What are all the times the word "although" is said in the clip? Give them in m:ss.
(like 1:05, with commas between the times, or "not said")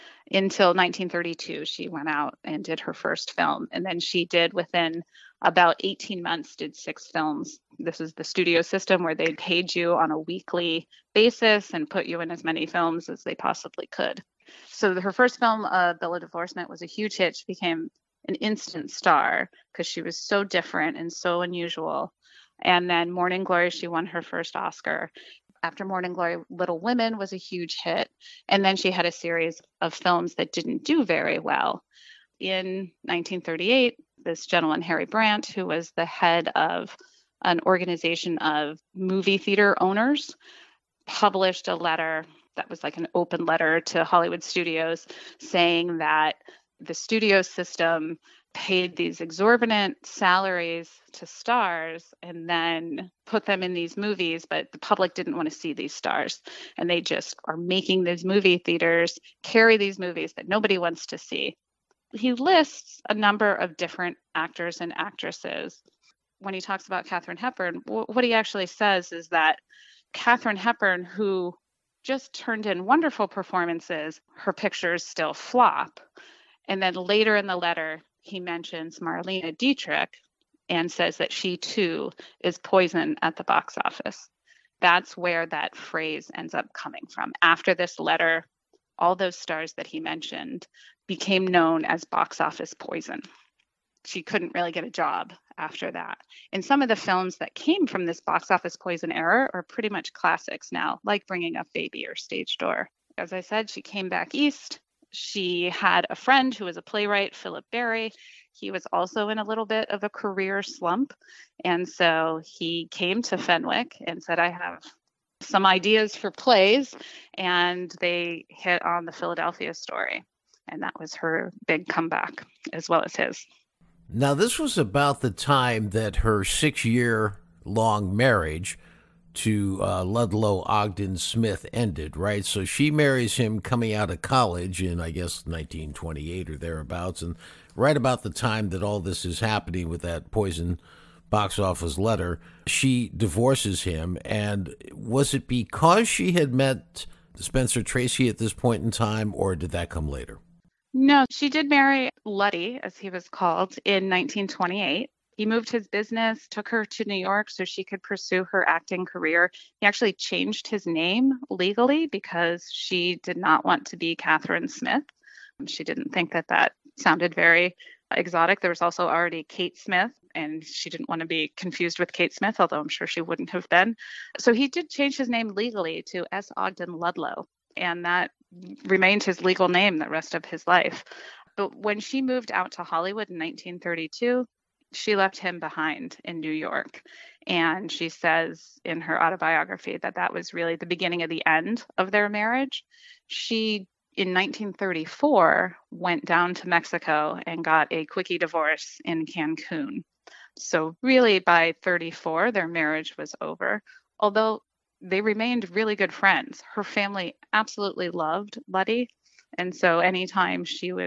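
2:52, 3:24.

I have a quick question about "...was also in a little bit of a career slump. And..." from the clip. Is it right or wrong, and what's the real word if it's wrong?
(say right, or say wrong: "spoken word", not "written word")
right.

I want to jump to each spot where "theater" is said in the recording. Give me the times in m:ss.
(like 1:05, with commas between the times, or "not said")
0:39, 0:58.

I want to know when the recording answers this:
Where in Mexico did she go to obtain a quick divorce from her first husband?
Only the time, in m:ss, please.
3:19.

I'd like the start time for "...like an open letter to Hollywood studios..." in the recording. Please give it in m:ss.
0:42.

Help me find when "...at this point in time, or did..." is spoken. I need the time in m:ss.
2:28.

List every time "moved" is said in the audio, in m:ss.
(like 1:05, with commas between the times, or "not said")
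2:35, 3:02.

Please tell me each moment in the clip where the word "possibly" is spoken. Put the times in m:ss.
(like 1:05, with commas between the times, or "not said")
0:13.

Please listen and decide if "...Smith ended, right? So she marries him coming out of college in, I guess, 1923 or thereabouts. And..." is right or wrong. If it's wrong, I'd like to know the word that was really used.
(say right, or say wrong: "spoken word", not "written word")
wrong: "1928", not "1923".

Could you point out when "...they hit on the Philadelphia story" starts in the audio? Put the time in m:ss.
1:57.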